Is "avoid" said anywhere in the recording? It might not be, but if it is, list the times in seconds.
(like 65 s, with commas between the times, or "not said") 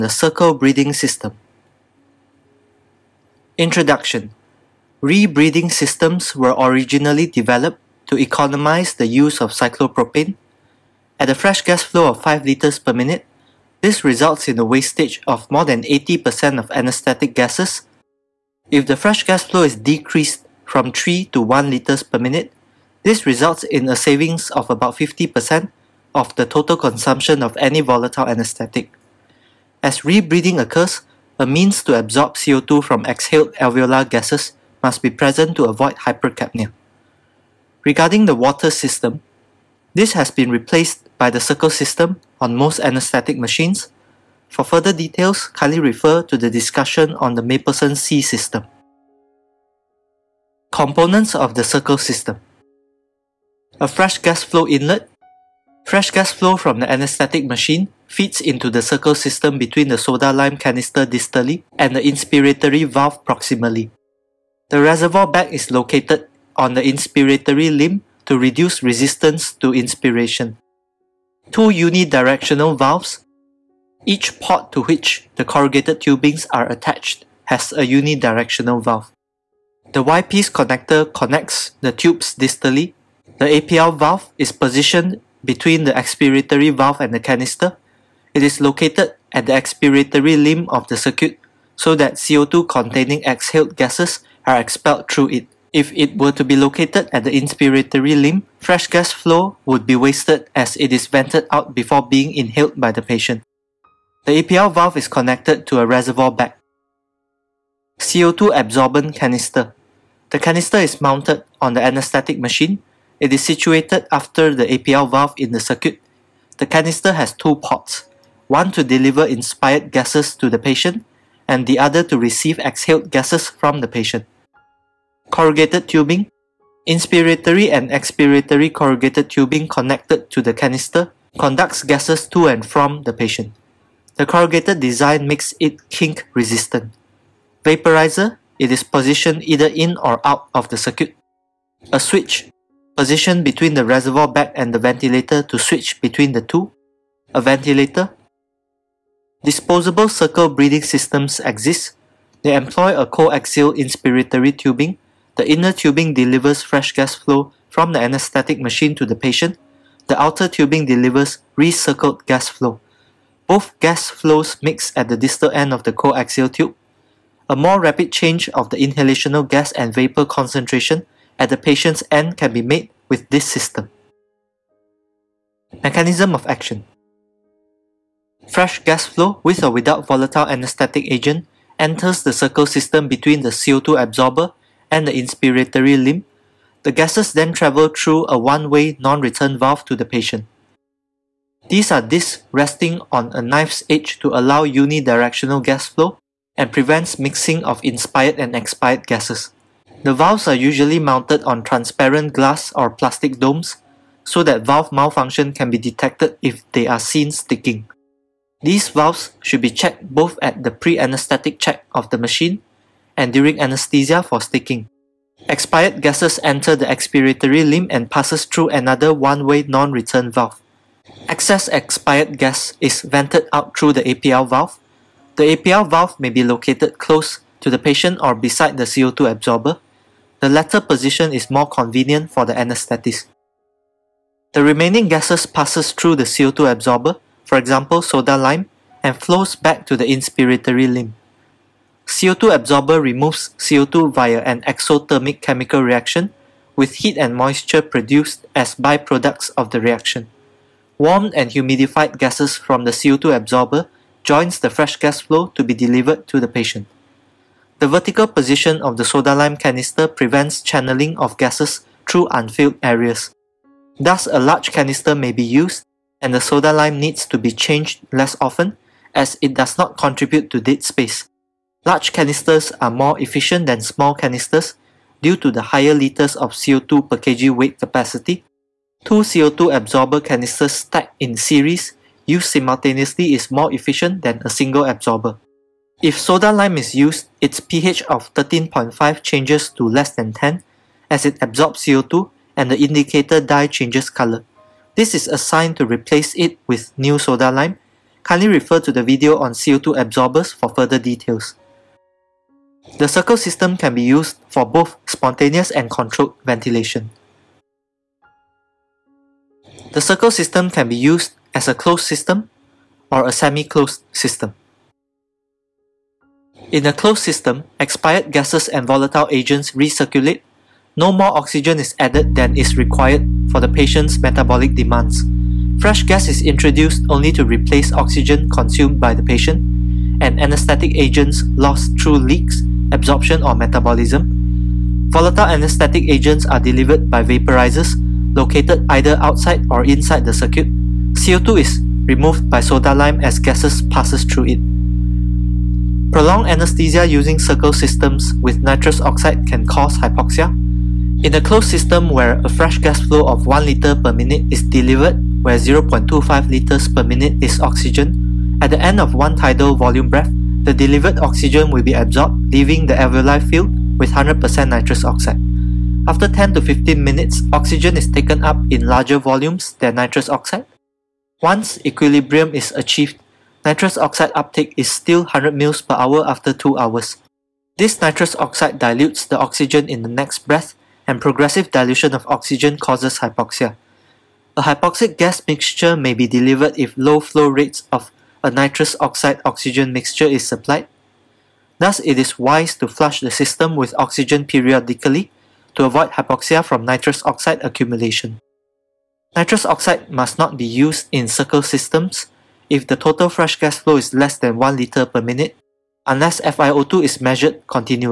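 35 s, 395 s.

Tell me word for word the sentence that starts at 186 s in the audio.
The gases then travel through a one-way non-return valve to the patient.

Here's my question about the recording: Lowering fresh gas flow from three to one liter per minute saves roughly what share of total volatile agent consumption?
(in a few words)
50%.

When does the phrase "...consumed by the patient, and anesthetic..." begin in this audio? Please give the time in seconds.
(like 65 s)
328 s.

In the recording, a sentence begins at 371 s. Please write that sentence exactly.
Once equilibrium is achieved, nitrous oxide uptake is still 100 mL per hour after 2 hours.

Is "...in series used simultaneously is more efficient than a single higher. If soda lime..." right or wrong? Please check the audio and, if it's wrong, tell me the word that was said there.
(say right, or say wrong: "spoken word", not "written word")
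wrong: "absorber", not "higher".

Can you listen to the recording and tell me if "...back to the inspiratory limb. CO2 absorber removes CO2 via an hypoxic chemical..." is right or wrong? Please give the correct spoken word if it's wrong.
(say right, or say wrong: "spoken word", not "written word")
wrong: "exothermic", not "hypoxic".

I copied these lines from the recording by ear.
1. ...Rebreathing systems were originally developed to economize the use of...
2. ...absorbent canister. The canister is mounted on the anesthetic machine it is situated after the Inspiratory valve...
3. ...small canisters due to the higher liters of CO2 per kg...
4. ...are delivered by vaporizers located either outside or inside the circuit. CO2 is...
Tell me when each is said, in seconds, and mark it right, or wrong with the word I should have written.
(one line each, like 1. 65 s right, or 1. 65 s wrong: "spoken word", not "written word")
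1. 5 s right
2. 108 s wrong: "APL", not "Inspiratory"
3. 273 s right
4. 336 s right.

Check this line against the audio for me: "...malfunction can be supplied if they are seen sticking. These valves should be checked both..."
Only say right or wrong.
wrong.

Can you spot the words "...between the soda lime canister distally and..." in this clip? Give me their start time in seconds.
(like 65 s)
59 s.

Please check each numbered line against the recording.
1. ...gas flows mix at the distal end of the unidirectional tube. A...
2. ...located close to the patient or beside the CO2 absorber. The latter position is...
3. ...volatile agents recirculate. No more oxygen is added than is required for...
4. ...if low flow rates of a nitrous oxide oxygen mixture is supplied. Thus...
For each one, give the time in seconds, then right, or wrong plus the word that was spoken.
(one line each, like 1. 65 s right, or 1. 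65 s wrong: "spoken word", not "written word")
1. 163 s wrong: "coaxial", not "unidirectional"
2. 226 s right
3. 318 s right
4. 386 s right.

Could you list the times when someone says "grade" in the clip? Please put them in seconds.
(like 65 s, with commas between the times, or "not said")
not said.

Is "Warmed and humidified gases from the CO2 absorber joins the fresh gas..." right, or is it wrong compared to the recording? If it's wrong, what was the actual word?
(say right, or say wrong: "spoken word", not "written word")
right.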